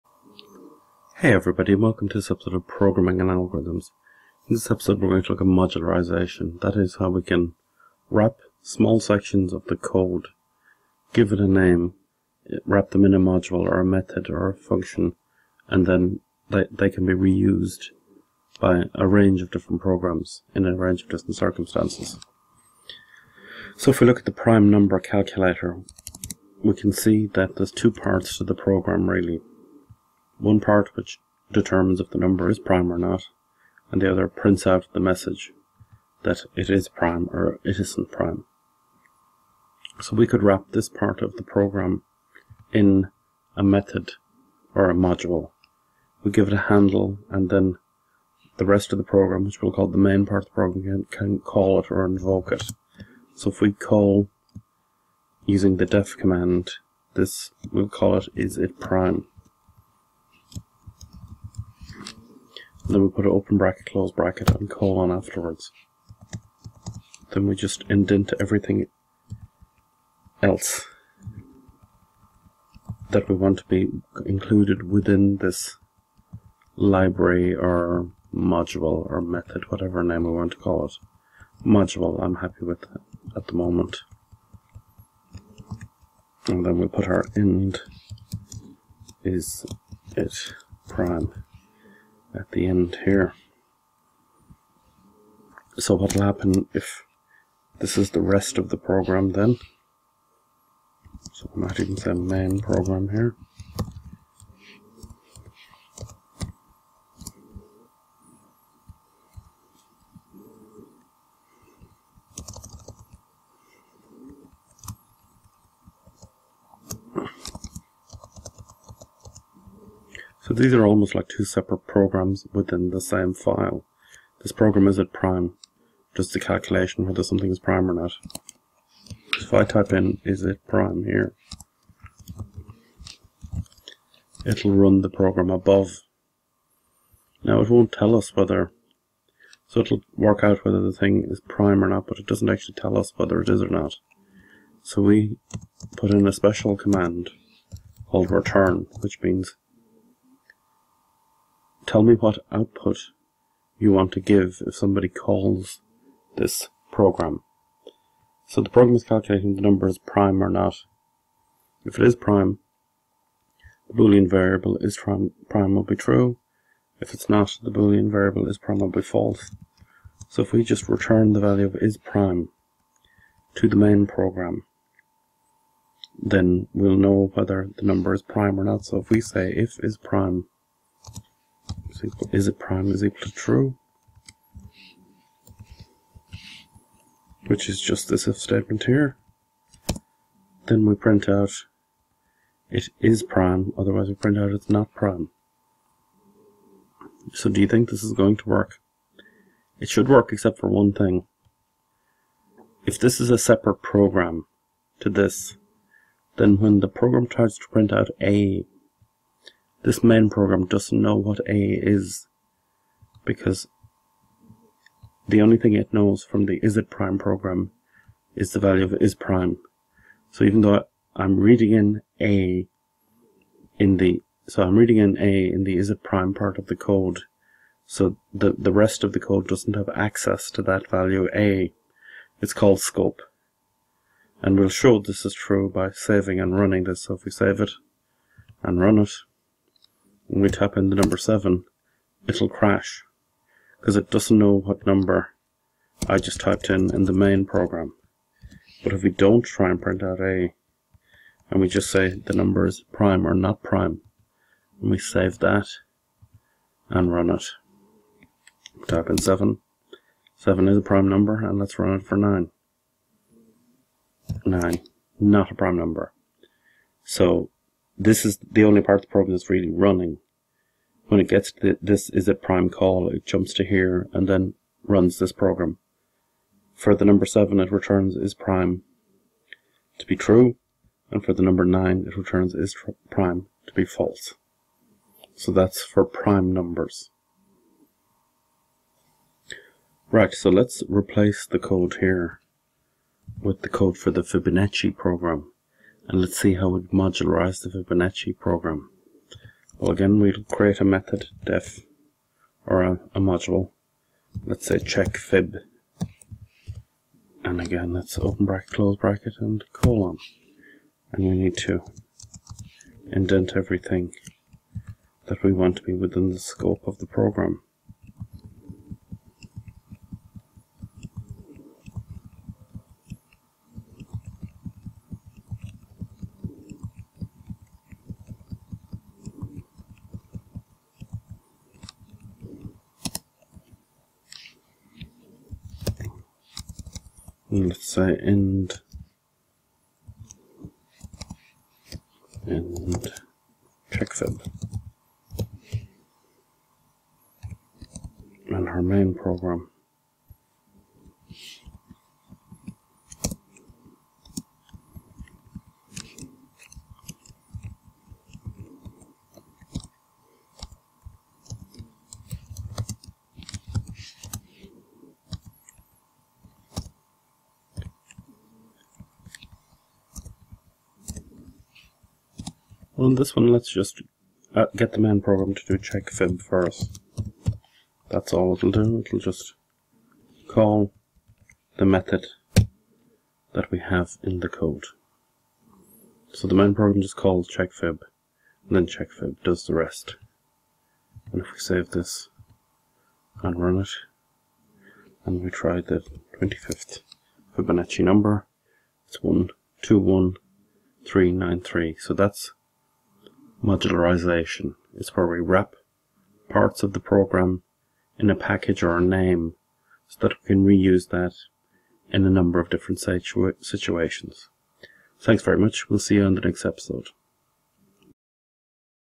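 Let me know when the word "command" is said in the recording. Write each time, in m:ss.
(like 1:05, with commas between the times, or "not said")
0:56, 2:26.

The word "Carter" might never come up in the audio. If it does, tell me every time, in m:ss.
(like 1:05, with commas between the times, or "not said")
not said.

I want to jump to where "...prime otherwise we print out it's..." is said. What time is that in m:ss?
3:13.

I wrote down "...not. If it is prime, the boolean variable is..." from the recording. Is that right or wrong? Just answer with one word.
right.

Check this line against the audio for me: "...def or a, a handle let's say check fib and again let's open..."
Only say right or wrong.
wrong.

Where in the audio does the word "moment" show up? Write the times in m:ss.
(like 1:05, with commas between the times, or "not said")
1:23.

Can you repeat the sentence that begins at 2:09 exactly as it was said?
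If I type in is it prime here, it'll run the program above.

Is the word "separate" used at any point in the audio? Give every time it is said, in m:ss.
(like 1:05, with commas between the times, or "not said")
2:01, 3:23.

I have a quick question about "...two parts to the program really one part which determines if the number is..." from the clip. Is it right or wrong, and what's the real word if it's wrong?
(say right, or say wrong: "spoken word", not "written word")
right.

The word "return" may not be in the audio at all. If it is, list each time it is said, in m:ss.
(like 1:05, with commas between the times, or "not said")
2:28, 2:50, 4:37, 4:42.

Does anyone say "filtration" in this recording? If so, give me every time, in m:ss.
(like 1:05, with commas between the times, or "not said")
not said.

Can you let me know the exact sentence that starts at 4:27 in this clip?
So this is the only part of the program that's really running.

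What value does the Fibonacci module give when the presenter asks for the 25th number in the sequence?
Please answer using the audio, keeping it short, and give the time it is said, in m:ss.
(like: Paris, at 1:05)
121393, at 6:39.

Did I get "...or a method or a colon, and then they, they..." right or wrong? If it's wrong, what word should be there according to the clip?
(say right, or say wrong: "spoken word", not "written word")
wrong: "function", not "colon".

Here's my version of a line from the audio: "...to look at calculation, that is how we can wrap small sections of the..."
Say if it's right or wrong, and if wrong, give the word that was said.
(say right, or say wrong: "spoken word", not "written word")
wrong: "modularization", not "calculation".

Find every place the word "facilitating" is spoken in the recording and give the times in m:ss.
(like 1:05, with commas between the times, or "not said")
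not said.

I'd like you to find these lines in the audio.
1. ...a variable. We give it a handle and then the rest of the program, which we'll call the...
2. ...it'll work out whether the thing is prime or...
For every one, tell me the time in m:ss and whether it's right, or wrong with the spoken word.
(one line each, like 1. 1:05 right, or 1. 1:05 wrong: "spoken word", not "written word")
1. 0:44 wrong: "module", not "variable"
2. 2:19 right.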